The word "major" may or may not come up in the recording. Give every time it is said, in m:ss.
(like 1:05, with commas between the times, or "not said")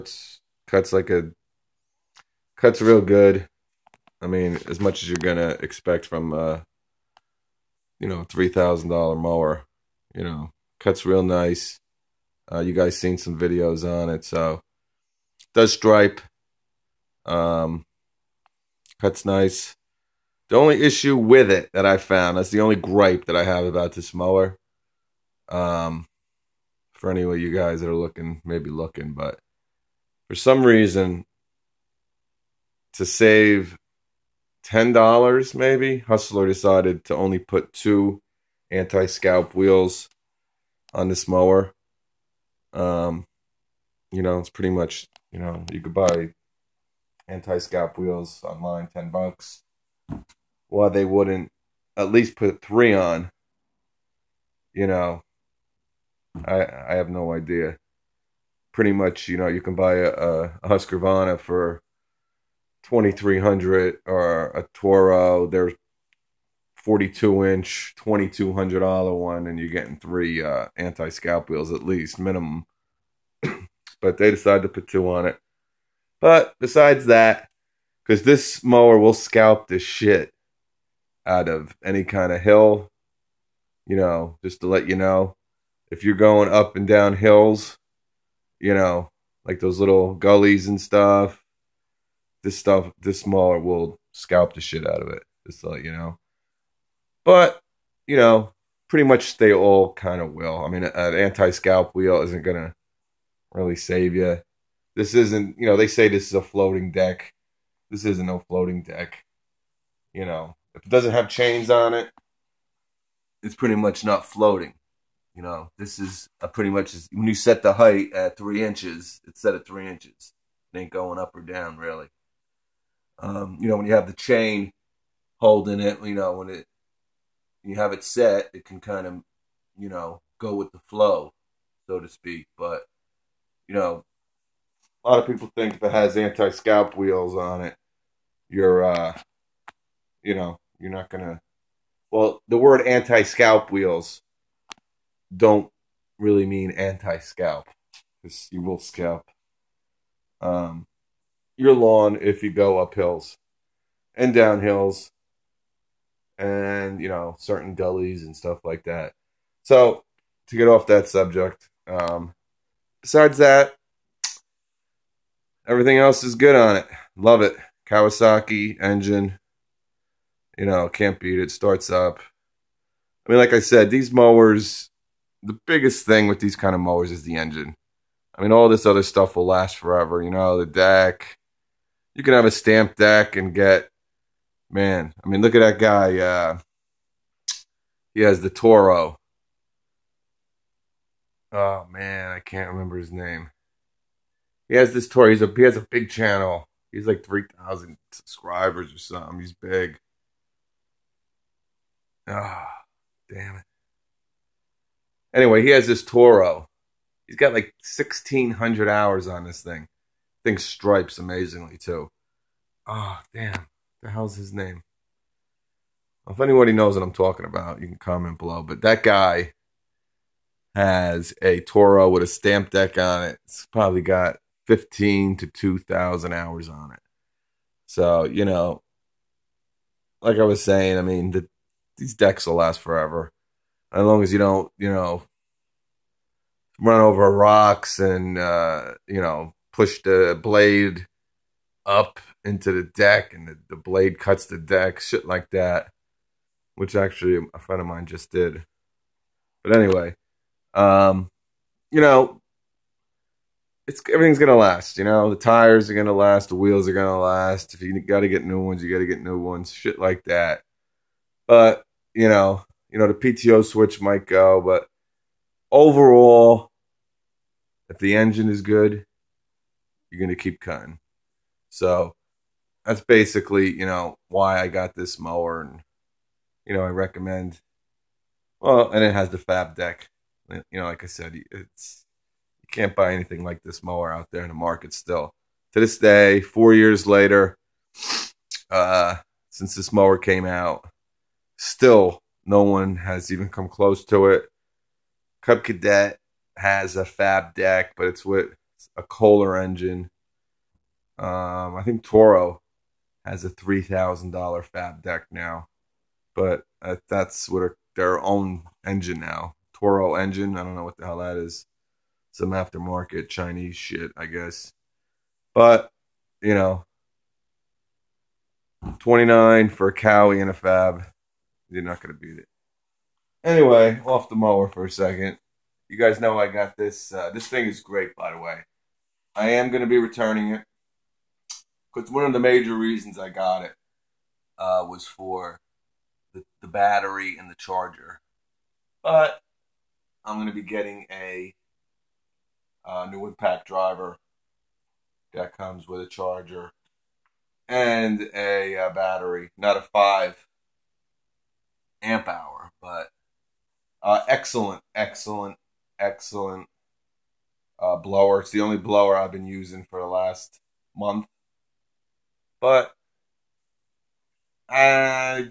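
5:32.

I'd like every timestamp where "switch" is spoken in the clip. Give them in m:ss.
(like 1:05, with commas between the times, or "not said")
4:23.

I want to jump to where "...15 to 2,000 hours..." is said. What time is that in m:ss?
3:44.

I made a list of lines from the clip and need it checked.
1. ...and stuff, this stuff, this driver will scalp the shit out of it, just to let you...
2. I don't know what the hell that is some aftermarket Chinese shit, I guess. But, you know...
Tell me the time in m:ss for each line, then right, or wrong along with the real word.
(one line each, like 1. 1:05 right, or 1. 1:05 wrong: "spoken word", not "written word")
1. 1:30 wrong: "mower", not "driver"
2. 5:10 right.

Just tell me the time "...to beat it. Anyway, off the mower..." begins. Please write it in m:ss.
5:22.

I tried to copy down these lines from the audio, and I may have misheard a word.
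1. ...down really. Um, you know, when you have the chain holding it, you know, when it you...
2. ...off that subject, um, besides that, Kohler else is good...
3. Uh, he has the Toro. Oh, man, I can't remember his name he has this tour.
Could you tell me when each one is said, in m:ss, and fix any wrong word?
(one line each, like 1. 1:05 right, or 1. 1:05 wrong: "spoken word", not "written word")
1. 2:01 right
2. 2:40 wrong: "Everything", not "Kohler"
3. 3:06 right.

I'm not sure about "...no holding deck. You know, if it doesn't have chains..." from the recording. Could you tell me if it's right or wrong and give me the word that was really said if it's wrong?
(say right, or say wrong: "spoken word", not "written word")
wrong: "floating", not "holding".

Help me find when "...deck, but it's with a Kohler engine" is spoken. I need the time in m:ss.
4:57.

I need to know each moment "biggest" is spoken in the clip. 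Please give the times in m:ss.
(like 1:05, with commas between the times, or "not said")
2:55.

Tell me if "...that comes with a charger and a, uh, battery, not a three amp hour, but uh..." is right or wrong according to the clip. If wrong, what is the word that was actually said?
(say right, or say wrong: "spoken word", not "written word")
wrong: "five", not "three".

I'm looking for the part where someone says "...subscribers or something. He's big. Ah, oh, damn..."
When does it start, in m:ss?
3:18.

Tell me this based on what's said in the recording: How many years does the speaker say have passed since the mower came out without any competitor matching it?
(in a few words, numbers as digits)
4.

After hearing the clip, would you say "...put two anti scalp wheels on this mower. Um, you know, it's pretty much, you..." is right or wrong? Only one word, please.
right.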